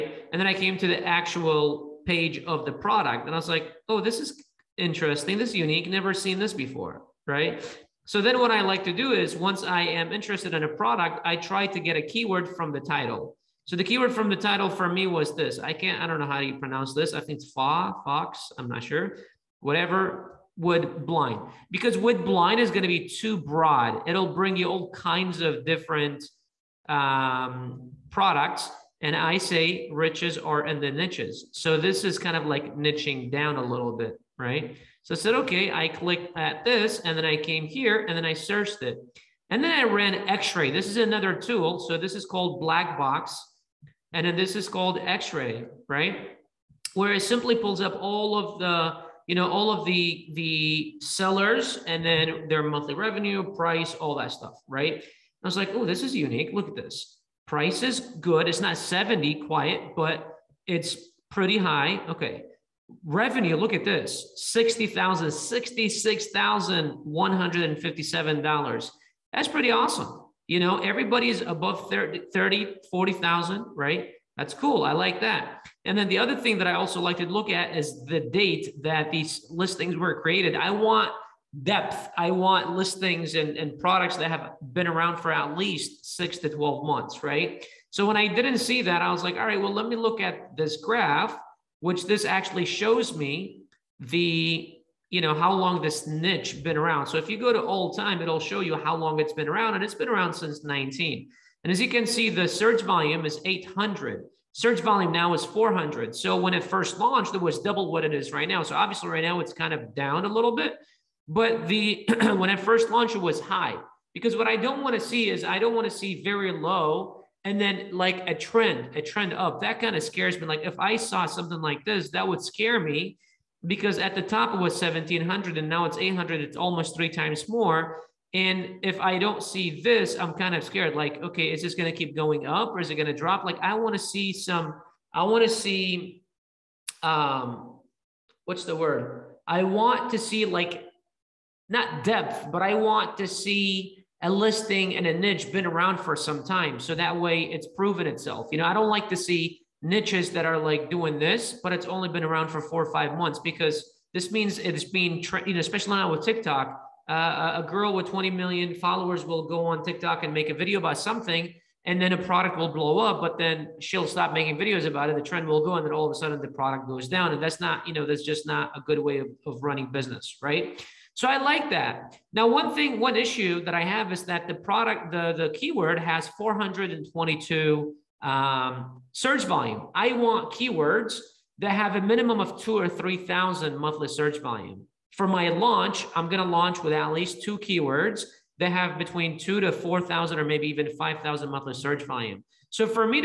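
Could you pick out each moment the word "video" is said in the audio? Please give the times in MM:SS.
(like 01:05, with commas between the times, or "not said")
02:40, 02:44.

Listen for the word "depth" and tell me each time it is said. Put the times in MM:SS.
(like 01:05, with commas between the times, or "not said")
01:21, 02:22.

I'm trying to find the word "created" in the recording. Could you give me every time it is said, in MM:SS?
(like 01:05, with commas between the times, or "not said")
01:20.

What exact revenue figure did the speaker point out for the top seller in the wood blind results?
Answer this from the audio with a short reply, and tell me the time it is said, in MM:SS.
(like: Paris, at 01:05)
$66,157, at 01:05.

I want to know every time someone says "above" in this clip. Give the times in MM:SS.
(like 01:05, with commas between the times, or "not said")
01:11.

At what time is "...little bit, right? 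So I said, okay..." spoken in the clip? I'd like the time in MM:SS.
00:33.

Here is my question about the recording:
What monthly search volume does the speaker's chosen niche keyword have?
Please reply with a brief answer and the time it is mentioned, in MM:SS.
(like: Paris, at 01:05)
422, at 02:56.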